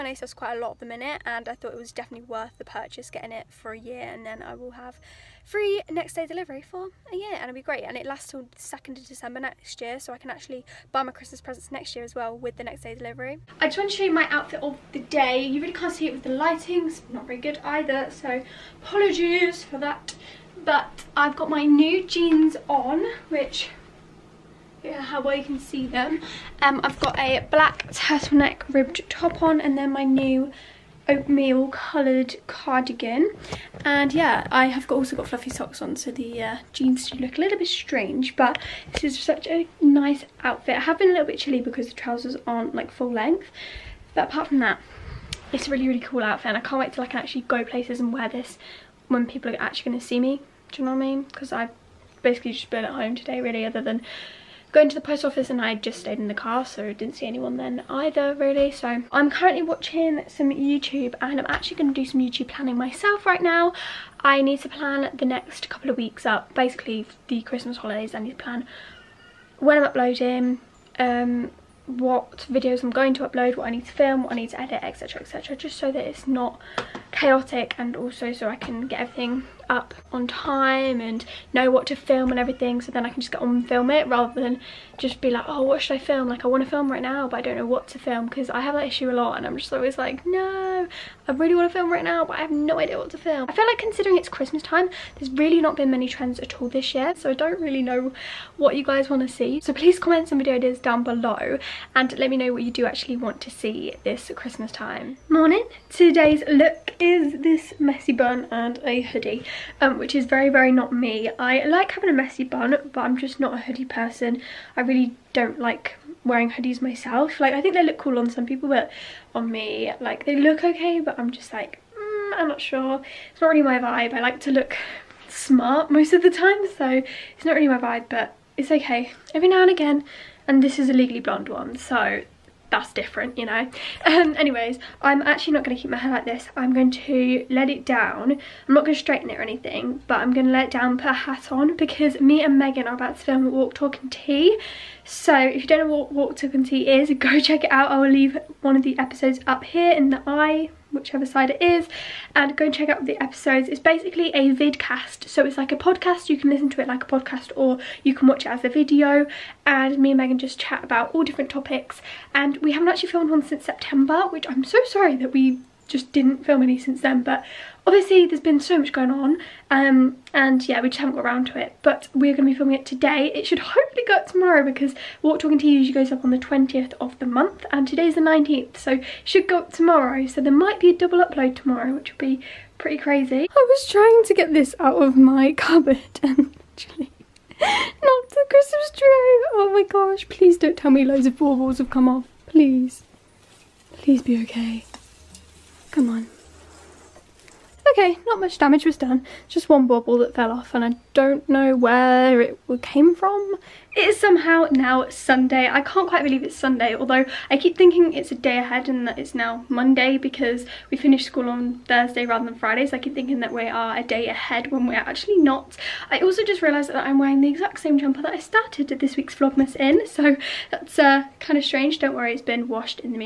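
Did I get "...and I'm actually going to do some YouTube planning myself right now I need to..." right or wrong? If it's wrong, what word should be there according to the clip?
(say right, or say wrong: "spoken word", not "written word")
right.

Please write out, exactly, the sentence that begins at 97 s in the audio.
So I don't really know what you guys want to see.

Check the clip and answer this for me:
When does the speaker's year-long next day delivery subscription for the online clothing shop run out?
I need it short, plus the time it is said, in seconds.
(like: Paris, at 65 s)
2 December, at 8 s.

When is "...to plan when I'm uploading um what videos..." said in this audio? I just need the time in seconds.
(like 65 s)
68 s.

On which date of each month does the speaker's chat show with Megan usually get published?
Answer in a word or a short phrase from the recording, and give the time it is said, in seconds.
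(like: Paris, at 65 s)
20th, at 176 s.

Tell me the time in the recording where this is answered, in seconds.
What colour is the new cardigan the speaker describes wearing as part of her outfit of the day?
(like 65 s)
31 s.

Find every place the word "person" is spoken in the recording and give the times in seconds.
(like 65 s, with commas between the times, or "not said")
113 s.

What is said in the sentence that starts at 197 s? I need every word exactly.
Okay, not much damage was done, just one bubble that fell off and I don't know where it came from.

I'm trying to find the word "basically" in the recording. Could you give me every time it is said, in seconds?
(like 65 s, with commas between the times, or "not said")
52 s, 66 s, 153 s.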